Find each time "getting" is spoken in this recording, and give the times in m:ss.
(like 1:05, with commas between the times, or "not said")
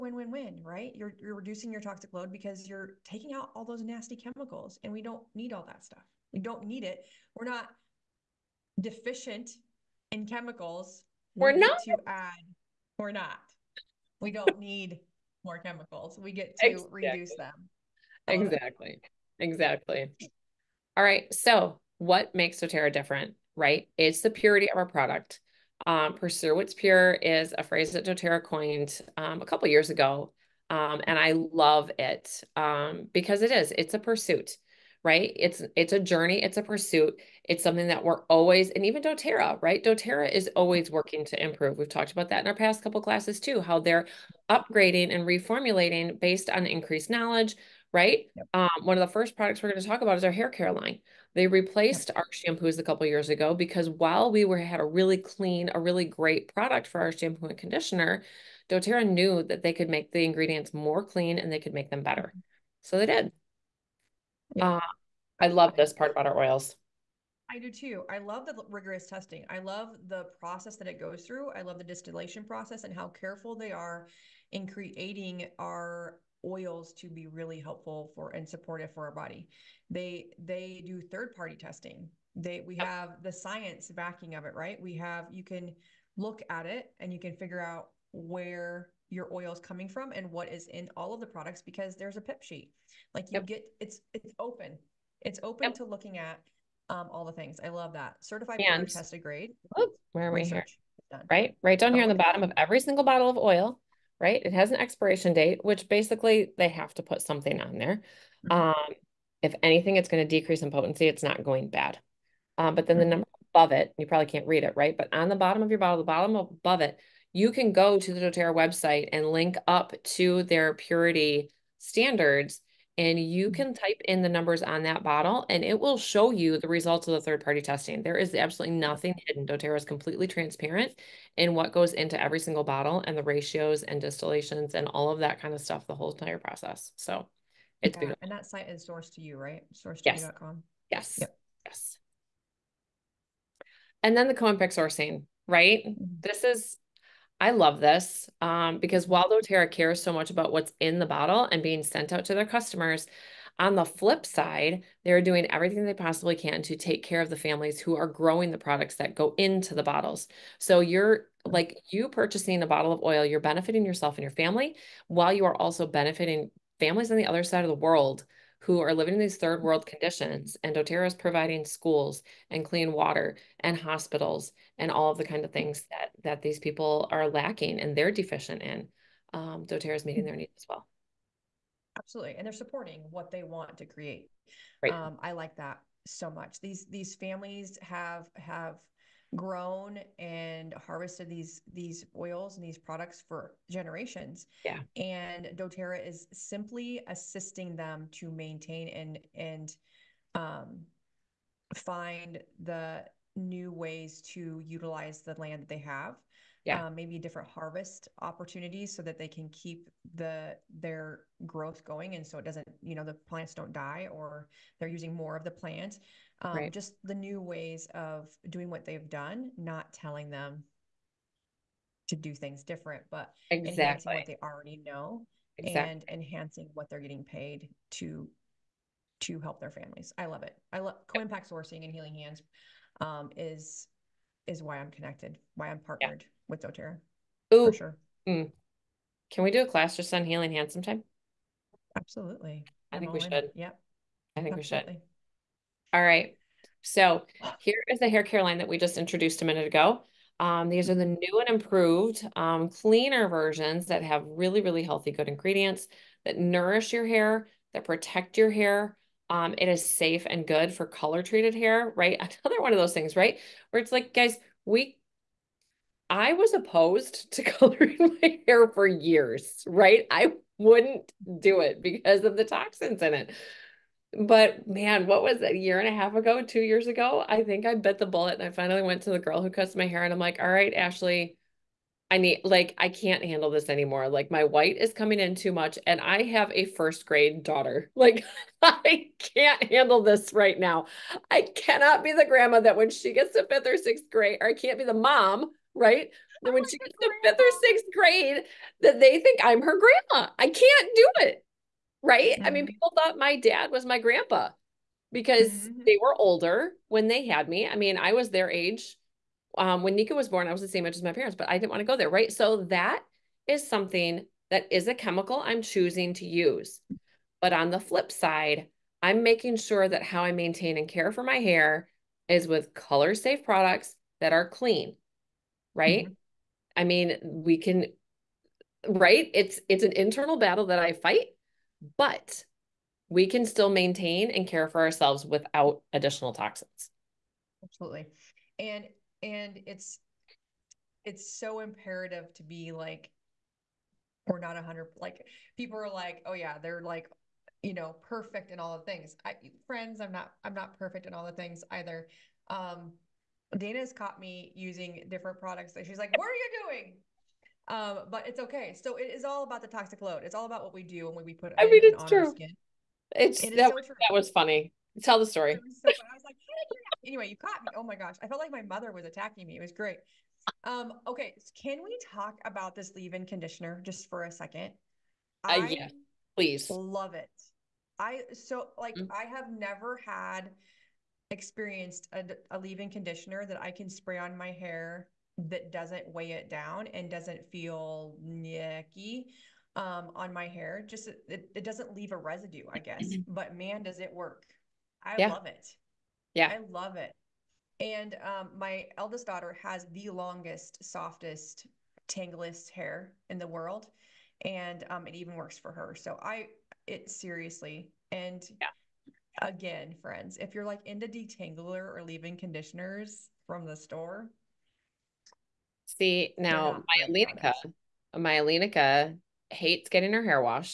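3:46, 6:59.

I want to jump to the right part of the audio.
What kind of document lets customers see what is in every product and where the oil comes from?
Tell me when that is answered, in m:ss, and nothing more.
1:32.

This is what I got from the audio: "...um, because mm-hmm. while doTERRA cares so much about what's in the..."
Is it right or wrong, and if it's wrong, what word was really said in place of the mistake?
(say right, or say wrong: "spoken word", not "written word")
right.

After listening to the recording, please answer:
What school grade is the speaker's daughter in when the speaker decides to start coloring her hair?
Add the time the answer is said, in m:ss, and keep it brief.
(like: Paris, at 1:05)
first grade, at 4:46.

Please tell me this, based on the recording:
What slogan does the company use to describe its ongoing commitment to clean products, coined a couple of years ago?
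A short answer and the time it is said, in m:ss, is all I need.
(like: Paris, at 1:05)
Pursue what's pure, at 0:26.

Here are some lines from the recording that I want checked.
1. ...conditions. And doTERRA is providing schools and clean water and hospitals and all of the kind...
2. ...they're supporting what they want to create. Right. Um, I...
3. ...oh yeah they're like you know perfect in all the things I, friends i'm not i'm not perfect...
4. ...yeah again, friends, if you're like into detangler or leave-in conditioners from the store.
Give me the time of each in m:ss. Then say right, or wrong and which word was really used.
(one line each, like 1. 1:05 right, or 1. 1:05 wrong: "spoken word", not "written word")
1. 2:49 right
2. 3:02 right
3. 5:46 right
4. 6:48 right.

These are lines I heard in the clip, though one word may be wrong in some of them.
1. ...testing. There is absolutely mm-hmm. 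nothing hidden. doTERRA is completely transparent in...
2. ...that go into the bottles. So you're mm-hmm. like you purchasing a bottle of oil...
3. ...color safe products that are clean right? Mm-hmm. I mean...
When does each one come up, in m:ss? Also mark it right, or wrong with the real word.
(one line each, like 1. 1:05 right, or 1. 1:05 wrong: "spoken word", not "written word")
1. 2:07 right
2. 2:38 right
3. 5:22 right.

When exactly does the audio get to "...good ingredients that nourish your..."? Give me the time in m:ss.
4:15.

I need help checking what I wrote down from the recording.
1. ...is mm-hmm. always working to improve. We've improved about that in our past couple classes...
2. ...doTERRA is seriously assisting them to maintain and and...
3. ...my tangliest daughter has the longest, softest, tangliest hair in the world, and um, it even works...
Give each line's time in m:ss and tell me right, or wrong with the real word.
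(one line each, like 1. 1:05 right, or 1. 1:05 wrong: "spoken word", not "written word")
1. 0:40 wrong: "talked", not "improved"
2. 3:15 wrong: "simply", not "seriously"
3. 6:38 wrong: "eldest", not "tangliest".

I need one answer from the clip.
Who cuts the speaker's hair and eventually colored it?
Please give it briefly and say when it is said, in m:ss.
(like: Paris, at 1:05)
Ashley, at 4:40.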